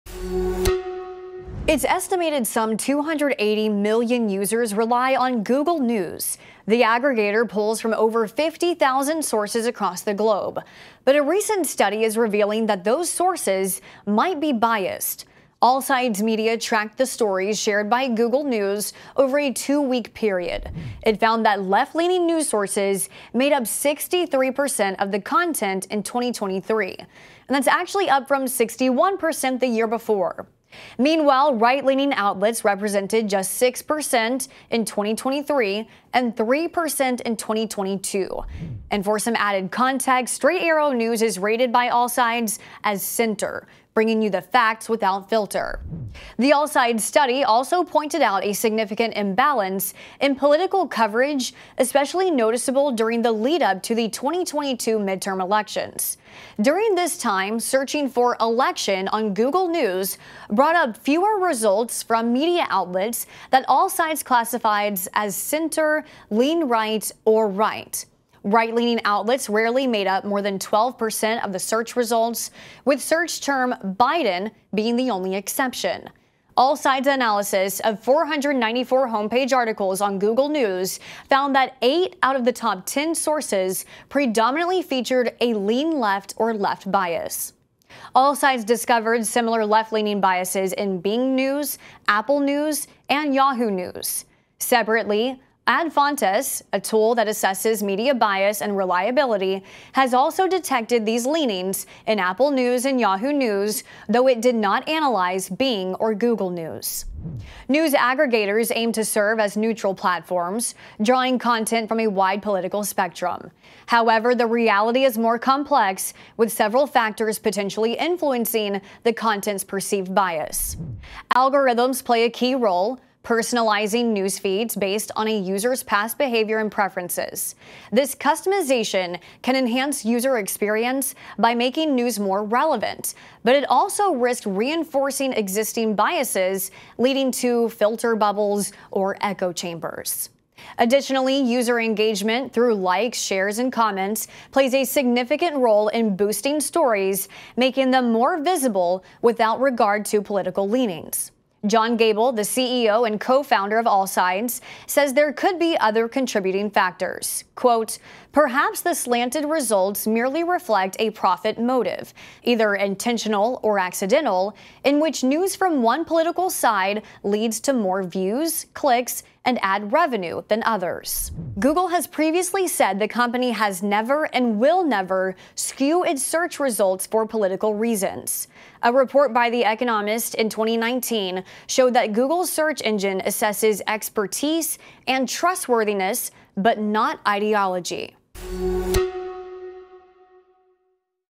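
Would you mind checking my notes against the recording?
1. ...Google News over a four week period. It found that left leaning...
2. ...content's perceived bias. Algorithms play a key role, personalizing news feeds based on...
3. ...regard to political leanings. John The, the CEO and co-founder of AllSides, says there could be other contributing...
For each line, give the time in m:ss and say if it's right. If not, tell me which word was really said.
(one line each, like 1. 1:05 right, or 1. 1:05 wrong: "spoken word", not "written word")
1. 0:18 wrong: "two", not "four"
2. 1:59 right
3. 2:29 wrong: "Gable", not "The".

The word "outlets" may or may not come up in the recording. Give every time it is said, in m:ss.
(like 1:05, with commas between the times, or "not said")
0:32, 1:02, 1:09.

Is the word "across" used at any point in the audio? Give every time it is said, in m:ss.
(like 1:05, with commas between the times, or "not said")
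0:09.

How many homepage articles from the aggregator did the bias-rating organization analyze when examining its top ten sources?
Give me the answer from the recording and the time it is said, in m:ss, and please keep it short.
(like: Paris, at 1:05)
494, at 1:18.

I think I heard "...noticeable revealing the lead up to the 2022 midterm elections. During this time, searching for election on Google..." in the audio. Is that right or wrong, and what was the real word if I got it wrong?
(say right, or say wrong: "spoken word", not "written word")
wrong: "during", not "revealing".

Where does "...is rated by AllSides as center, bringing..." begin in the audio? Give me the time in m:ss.
0:41.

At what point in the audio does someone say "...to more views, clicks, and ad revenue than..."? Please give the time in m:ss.
2:47.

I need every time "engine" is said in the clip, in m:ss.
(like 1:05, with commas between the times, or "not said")
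3:02.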